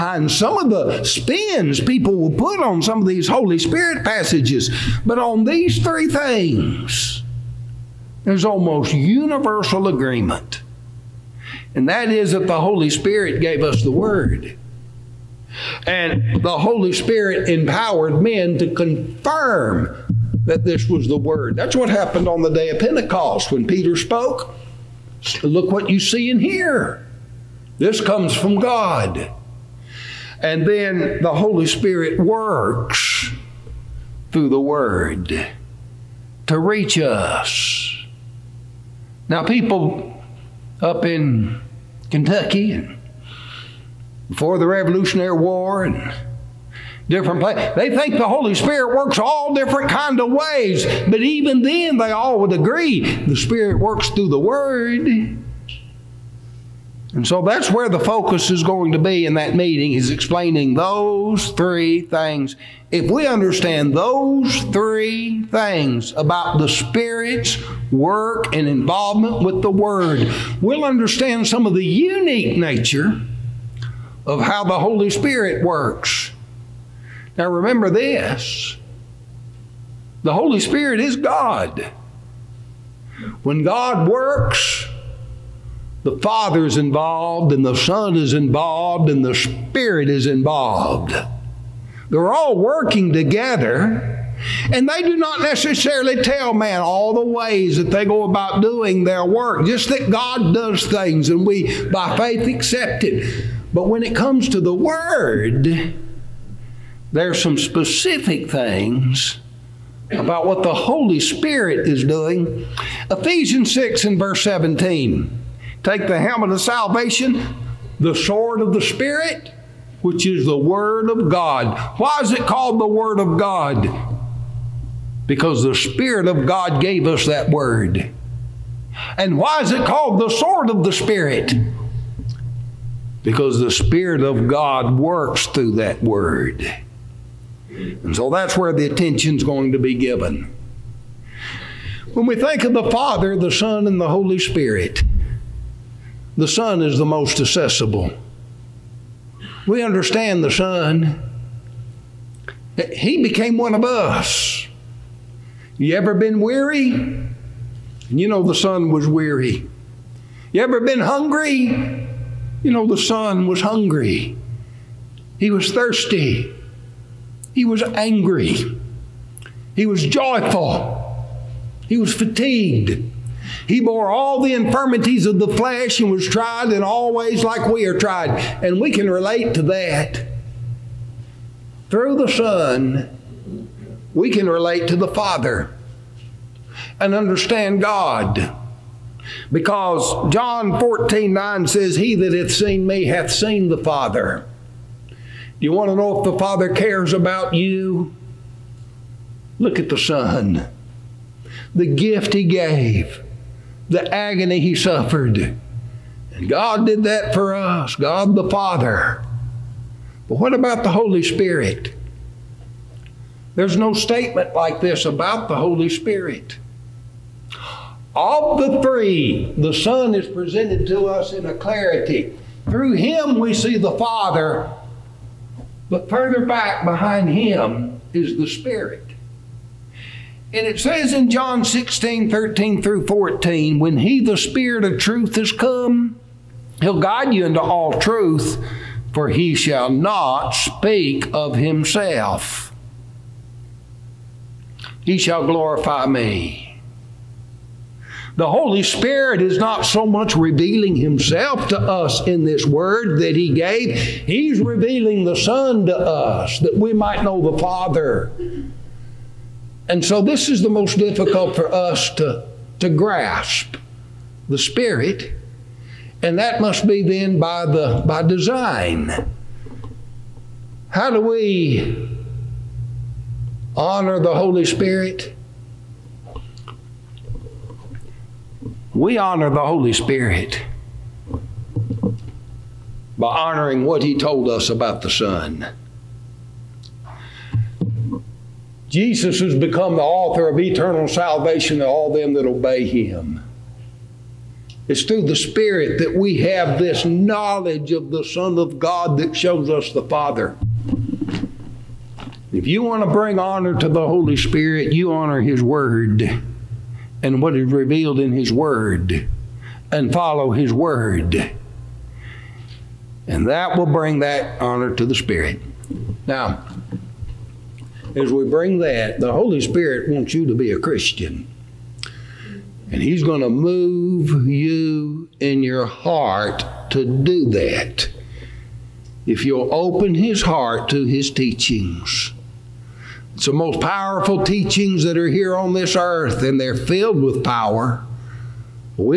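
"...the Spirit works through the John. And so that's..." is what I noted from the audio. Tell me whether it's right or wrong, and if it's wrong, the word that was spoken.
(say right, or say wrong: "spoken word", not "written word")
wrong: "Word", not "John".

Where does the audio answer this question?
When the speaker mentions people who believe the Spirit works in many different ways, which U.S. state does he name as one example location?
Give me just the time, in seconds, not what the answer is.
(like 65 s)
42 s.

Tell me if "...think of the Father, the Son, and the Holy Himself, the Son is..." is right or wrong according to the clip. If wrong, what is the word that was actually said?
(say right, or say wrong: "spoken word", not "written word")
wrong: "Spirit", not "Himself".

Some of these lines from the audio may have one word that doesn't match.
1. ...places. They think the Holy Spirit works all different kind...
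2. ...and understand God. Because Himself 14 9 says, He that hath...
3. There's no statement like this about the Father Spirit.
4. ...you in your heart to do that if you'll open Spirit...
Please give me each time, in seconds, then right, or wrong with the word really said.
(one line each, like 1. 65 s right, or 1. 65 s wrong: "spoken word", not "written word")
1. 47 s right
2. 186 s wrong: "John", not "Himself"
3. 213 s wrong: "Holy", not "Father"
4. 324 s wrong: "His", not "Spirit".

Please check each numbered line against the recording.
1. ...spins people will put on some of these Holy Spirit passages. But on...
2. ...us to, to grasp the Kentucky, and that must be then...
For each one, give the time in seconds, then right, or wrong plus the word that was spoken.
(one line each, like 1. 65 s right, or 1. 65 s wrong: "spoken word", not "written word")
1. 1 s right
2. 261 s wrong: "Spirit", not "Kentucky".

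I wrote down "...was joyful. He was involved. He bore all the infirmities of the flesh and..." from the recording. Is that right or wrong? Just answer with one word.
wrong.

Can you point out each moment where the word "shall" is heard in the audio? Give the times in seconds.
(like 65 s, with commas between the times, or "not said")
239 s, 245 s.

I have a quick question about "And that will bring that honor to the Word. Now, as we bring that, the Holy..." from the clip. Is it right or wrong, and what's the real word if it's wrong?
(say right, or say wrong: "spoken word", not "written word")
wrong: "Spirit", not "Word".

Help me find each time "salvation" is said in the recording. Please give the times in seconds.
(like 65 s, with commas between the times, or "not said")
116 s, 291 s.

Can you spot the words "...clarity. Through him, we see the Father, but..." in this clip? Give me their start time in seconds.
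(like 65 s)
221 s.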